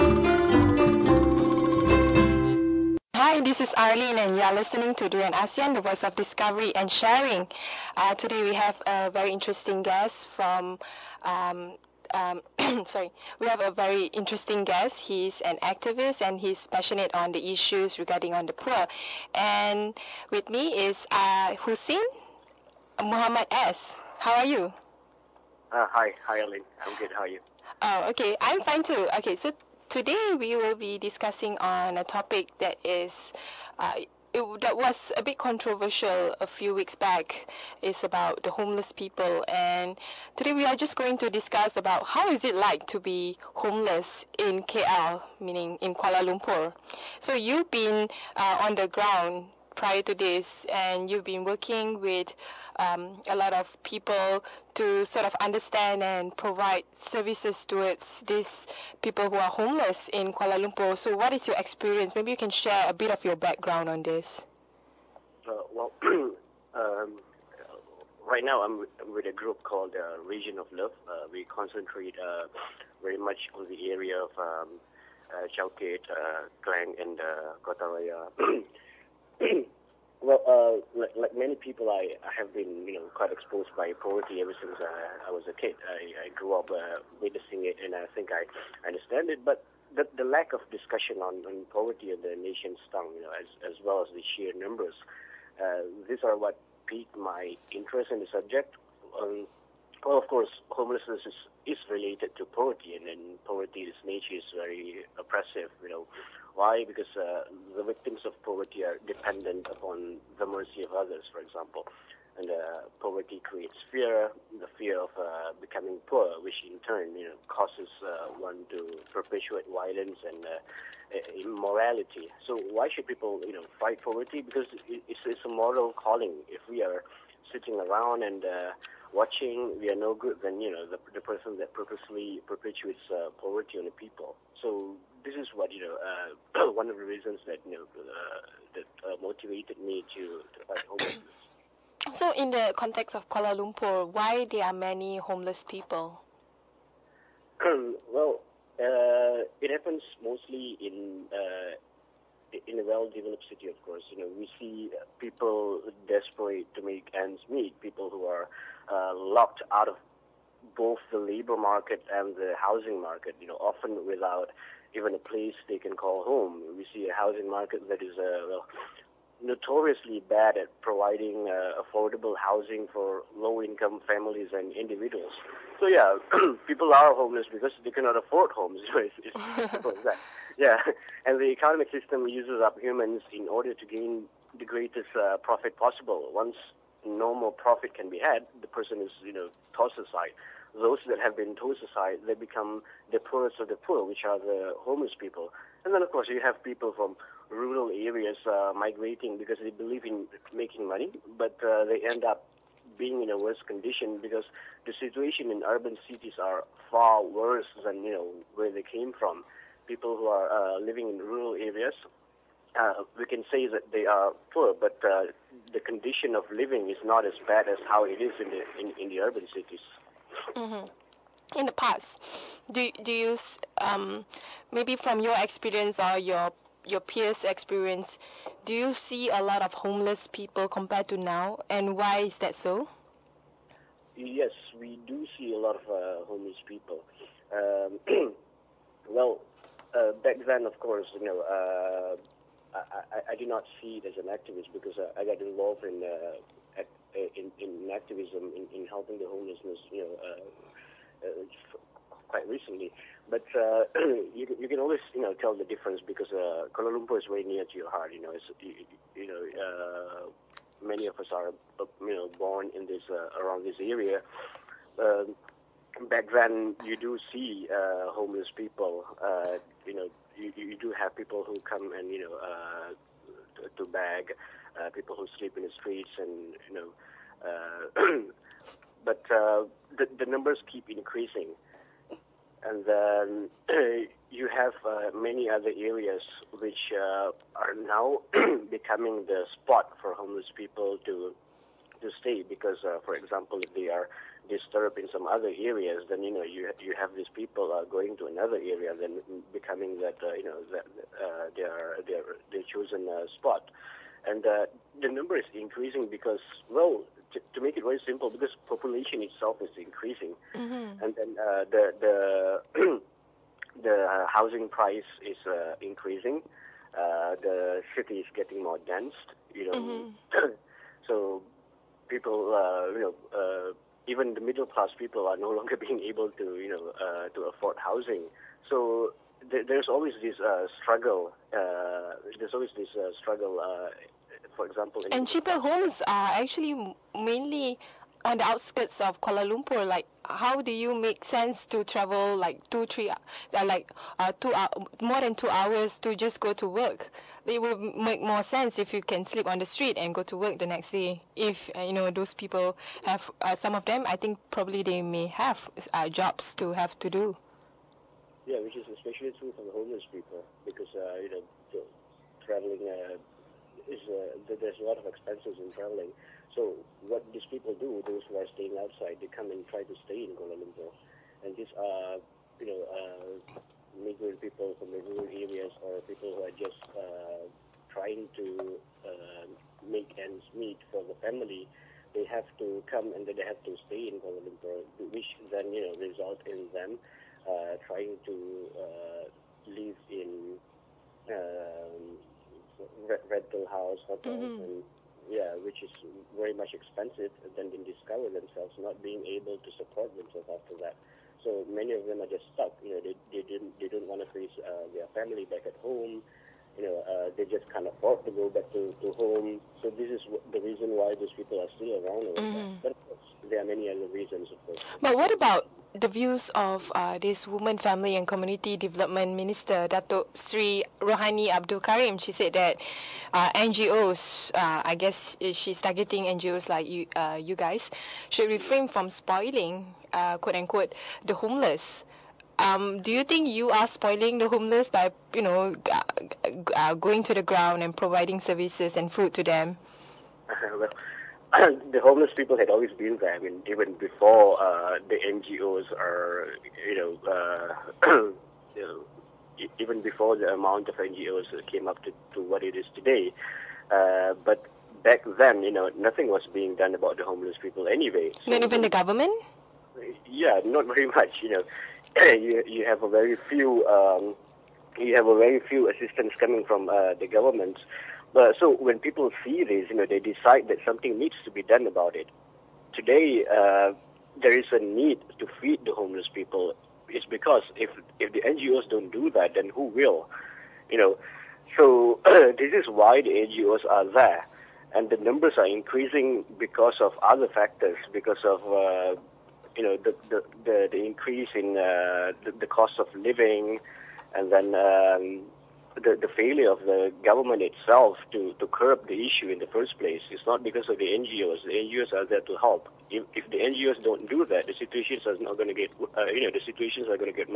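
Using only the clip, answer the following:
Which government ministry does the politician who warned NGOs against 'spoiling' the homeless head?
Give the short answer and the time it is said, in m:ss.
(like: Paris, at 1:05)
Women, Family and Community Development, at 6:57.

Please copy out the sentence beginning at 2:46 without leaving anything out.
We see a housing market that is uh, well, notoriously bad at providing uh, affordable housing for low-income families and individuals.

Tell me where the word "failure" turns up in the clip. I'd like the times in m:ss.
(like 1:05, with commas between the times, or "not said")
8:16.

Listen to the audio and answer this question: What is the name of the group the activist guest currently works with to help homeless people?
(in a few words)
Region of Love.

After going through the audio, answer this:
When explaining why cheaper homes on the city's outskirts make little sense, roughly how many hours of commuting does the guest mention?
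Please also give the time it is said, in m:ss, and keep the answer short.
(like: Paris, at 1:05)
more than 2 hours, at 5:45.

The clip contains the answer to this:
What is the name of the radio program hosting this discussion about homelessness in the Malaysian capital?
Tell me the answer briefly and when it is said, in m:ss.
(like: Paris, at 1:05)
Durian ASEAN, at 0:05.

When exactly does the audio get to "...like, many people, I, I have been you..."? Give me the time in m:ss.
1:21.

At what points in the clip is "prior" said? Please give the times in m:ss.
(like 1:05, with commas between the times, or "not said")
0:49.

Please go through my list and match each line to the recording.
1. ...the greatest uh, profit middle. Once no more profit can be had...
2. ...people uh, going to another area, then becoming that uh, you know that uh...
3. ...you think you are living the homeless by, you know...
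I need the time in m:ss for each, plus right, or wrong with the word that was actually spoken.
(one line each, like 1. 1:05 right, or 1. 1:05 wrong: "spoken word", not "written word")
1. 3:04 wrong: "possible", not "middle"
2. 4:57 right
3. 7:13 wrong: "spoiling", not "living".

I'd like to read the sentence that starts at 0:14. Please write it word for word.
He's an activist and he's passionate on the issues regarding on the poor.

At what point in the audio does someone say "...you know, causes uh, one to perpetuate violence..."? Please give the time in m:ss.
1:57.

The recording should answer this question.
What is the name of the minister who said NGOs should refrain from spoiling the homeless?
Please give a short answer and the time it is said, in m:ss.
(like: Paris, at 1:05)
Rohani Abdul Karim, at 7:01.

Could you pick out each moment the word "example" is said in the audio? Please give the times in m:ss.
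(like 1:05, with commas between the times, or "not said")
1:51, 4:53, 5:34.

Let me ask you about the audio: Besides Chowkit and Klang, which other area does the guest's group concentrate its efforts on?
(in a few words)
Kota Raya.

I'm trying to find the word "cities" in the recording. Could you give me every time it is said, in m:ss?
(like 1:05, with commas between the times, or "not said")
3:26, 3:39.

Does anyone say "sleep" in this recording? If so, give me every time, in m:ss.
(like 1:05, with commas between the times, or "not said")
4:35, 5:49.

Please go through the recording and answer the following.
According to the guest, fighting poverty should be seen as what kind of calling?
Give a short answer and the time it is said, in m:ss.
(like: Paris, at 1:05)
a moral calling, at 2:05.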